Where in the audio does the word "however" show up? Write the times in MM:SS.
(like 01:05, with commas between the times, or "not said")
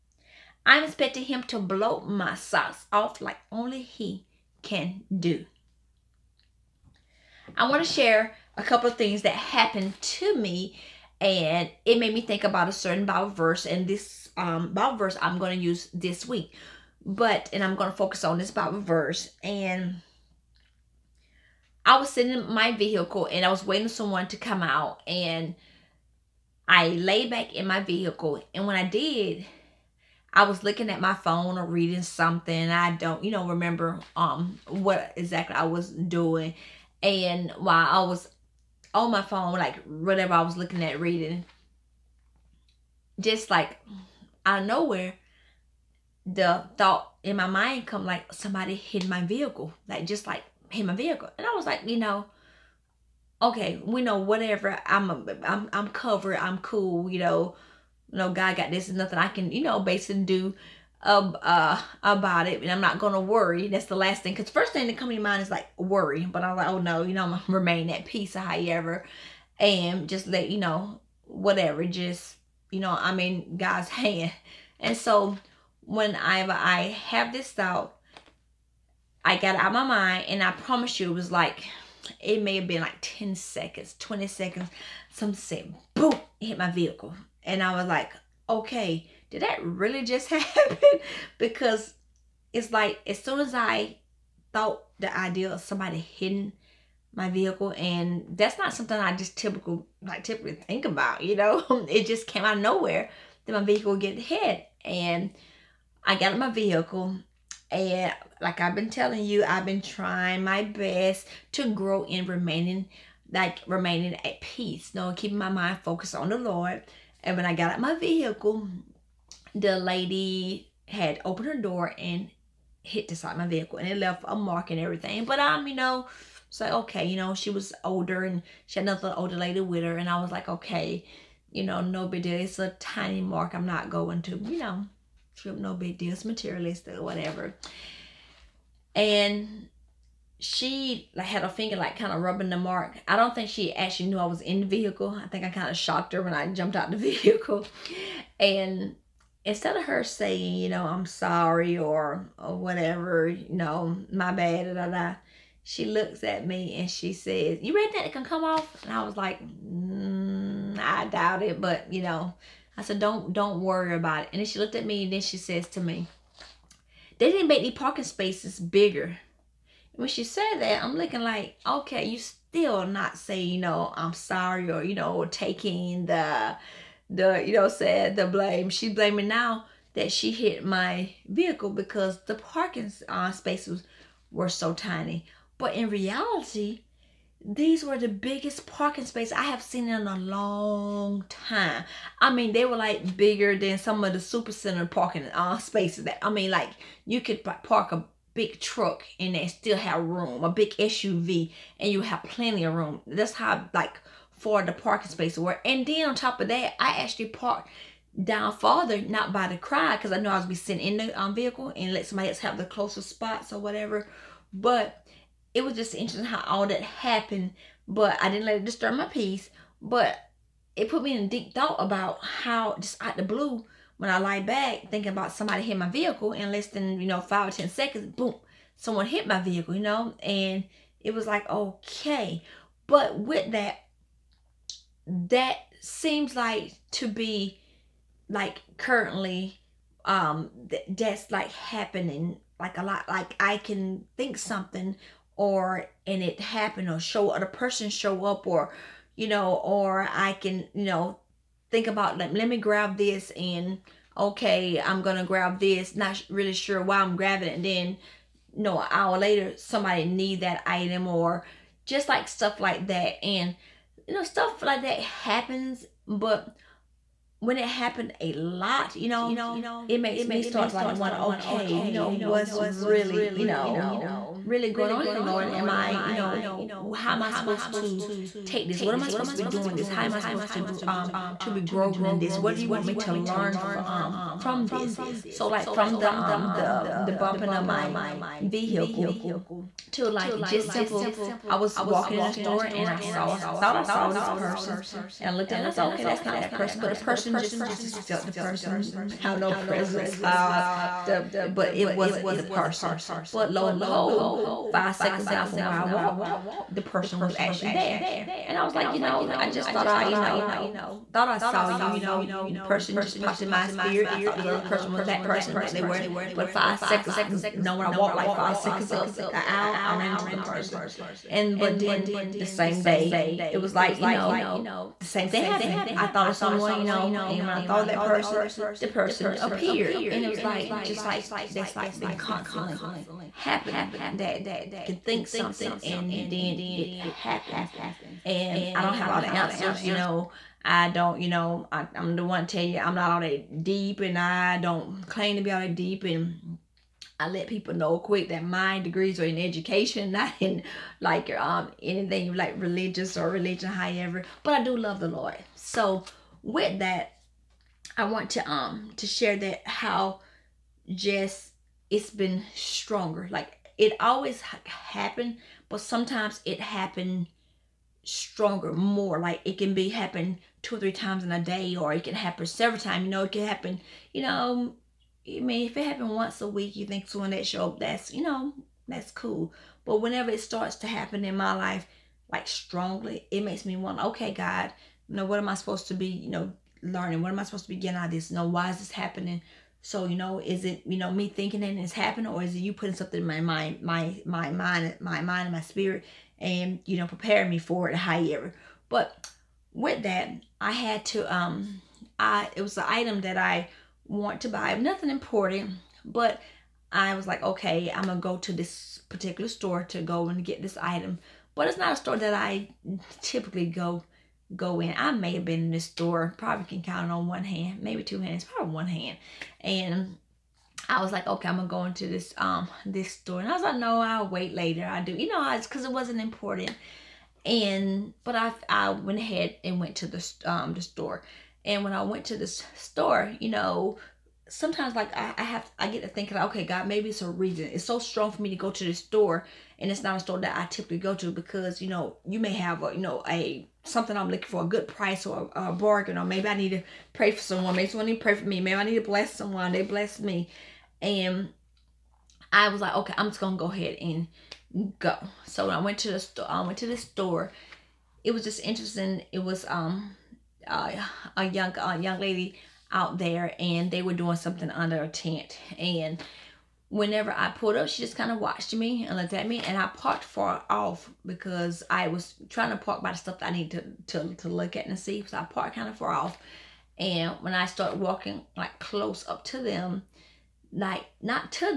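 01:08, 05:53, 06:37.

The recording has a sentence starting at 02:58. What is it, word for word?
She's blaming now that she hit my vehicle because the parking uh, spaces were so tiny.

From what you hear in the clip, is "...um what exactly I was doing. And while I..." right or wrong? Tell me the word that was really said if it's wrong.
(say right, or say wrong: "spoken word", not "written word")
right.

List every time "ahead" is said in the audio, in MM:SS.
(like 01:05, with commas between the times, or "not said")
07:09, 07:33.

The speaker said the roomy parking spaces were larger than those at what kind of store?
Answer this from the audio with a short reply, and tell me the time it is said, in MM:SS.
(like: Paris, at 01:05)
super center, at 03:14.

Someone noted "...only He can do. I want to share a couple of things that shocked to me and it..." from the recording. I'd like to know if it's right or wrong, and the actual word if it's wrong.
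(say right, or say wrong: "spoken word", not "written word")
wrong: "happened", not "shocked".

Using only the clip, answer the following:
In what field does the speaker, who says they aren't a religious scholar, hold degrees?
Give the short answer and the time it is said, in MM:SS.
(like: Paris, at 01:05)
education, at 05:49.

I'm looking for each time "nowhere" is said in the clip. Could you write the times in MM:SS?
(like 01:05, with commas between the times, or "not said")
00:44, 01:42.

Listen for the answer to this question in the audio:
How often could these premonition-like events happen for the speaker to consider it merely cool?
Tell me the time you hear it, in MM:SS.
06:16.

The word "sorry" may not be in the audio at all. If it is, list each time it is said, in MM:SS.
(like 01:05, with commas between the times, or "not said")
02:31, 02:54.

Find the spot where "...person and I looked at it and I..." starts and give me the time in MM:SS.
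04:54.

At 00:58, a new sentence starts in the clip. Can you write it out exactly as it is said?
Nothing I can you know basically do ab- uh, about it and I'm not going to worry.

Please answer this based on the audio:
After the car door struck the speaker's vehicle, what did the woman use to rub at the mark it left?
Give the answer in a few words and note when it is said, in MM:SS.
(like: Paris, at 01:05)
a finger, at 02:21.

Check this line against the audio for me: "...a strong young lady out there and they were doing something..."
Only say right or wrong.
wrong.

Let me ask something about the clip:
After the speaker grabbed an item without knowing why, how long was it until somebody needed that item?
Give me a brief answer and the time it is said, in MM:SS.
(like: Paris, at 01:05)
an hour later, at 04:18.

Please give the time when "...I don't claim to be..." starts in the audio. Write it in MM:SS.
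05:44.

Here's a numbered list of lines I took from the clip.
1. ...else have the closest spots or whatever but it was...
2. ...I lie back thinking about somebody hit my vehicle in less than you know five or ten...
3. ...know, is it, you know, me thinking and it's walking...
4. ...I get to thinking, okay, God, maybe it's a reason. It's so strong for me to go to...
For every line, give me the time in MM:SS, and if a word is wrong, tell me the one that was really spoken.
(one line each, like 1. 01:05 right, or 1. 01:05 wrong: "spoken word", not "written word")
1. 03:32 right
2. 03:44 right
3. 06:30 wrong: "happening", not "walking"
4. 07:15 right.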